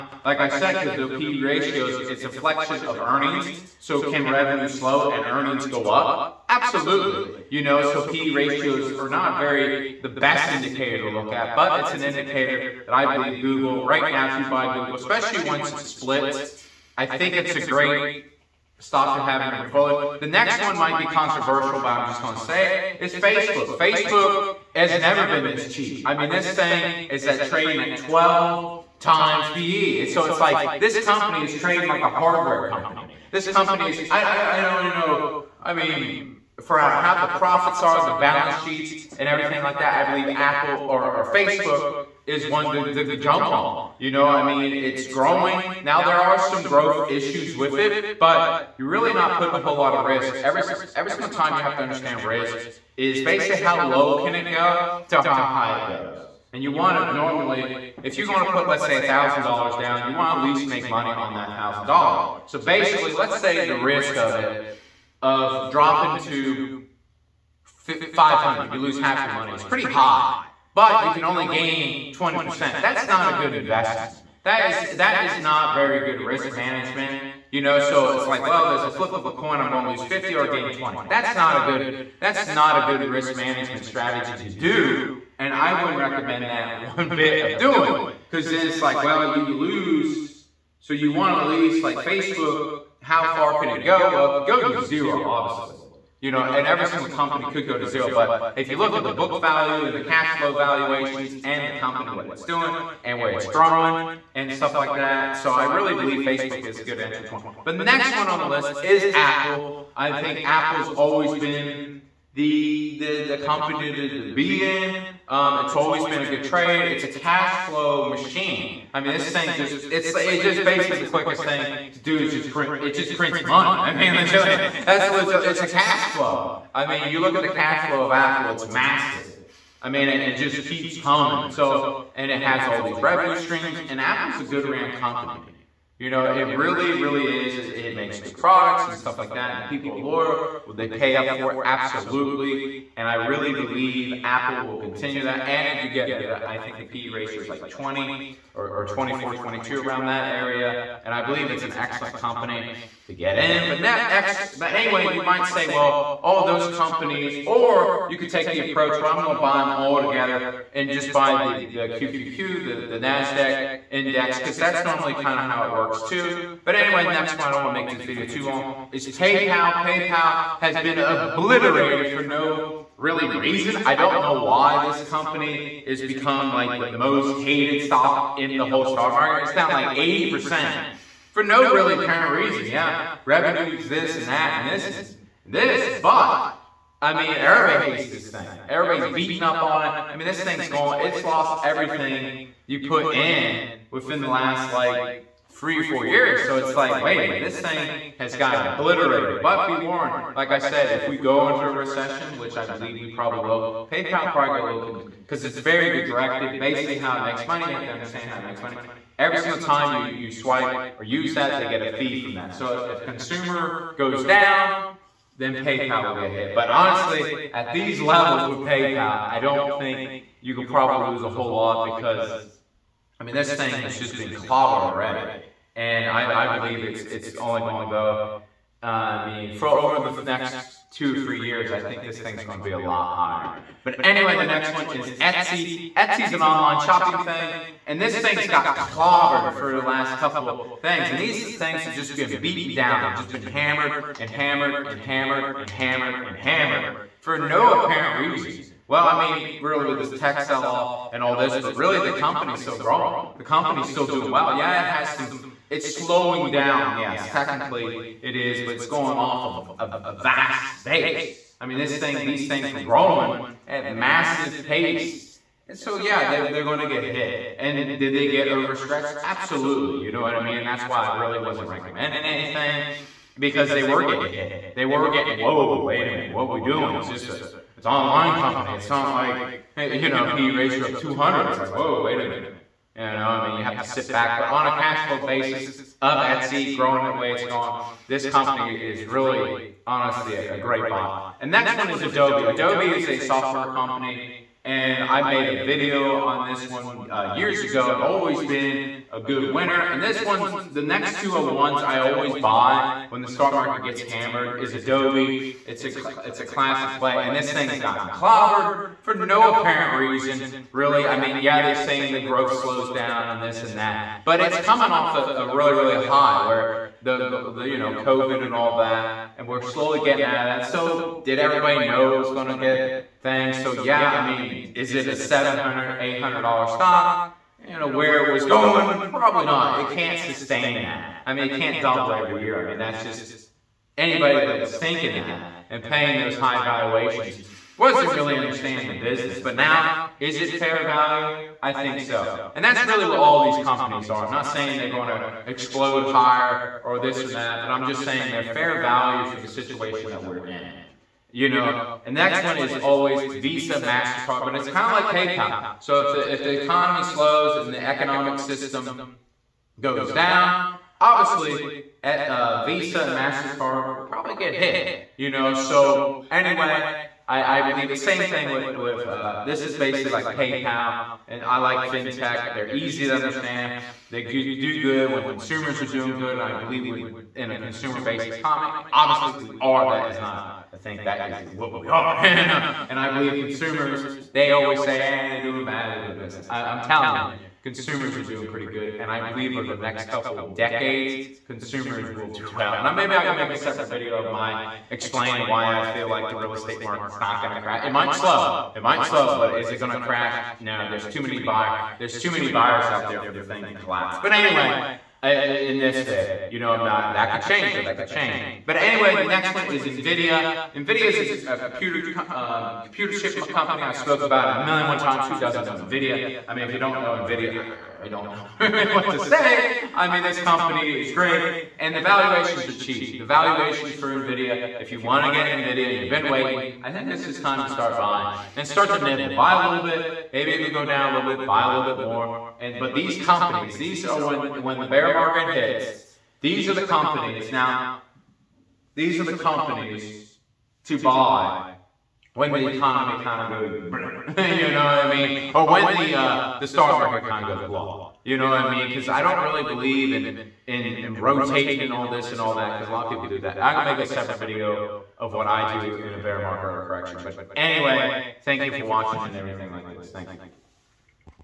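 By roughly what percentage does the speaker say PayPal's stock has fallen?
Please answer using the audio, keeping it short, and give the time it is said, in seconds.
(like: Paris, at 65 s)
80%, at 179 s.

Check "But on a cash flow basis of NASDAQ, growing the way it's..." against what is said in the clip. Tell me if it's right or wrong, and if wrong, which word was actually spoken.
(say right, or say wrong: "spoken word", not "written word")
wrong: "Etsy", not "NASDAQ".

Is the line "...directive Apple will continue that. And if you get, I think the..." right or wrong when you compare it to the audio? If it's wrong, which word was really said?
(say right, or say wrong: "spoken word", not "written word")
wrong: "believe", not "directive".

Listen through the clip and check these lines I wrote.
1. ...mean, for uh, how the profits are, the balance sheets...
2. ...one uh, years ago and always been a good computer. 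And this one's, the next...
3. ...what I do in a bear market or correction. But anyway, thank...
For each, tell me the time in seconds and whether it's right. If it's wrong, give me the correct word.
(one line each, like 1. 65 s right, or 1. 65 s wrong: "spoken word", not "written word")
1. 35 s right
2. 296 s wrong: "winner", not "computer"
3. 455 s right.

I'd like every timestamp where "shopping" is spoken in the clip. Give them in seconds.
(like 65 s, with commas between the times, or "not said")
236 s.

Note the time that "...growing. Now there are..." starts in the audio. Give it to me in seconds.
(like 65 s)
45 s.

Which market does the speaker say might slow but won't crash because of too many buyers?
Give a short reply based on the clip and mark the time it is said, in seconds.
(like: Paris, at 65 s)
real estate market, at 396 s.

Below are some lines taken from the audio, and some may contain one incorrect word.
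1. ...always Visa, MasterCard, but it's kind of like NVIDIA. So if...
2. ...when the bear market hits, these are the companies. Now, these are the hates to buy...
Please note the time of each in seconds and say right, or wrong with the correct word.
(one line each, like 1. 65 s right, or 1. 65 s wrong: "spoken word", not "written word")
1. 352 s wrong: "PayPal", not "NVIDIA"
2. 434 s wrong: "companies", not "hates".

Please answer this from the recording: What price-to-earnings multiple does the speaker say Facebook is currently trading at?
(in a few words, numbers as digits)
12.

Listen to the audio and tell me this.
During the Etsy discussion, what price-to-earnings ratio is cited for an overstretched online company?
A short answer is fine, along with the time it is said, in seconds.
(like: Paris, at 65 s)
200, at 280 s.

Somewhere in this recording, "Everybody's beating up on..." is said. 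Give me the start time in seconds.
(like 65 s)
188 s.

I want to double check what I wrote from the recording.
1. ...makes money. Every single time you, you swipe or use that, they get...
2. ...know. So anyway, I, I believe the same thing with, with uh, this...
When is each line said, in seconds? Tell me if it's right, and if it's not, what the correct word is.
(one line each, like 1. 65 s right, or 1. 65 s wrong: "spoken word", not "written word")
1. 208 s right
2. 365 s right.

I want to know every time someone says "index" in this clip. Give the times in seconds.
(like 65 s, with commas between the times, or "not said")
163 s.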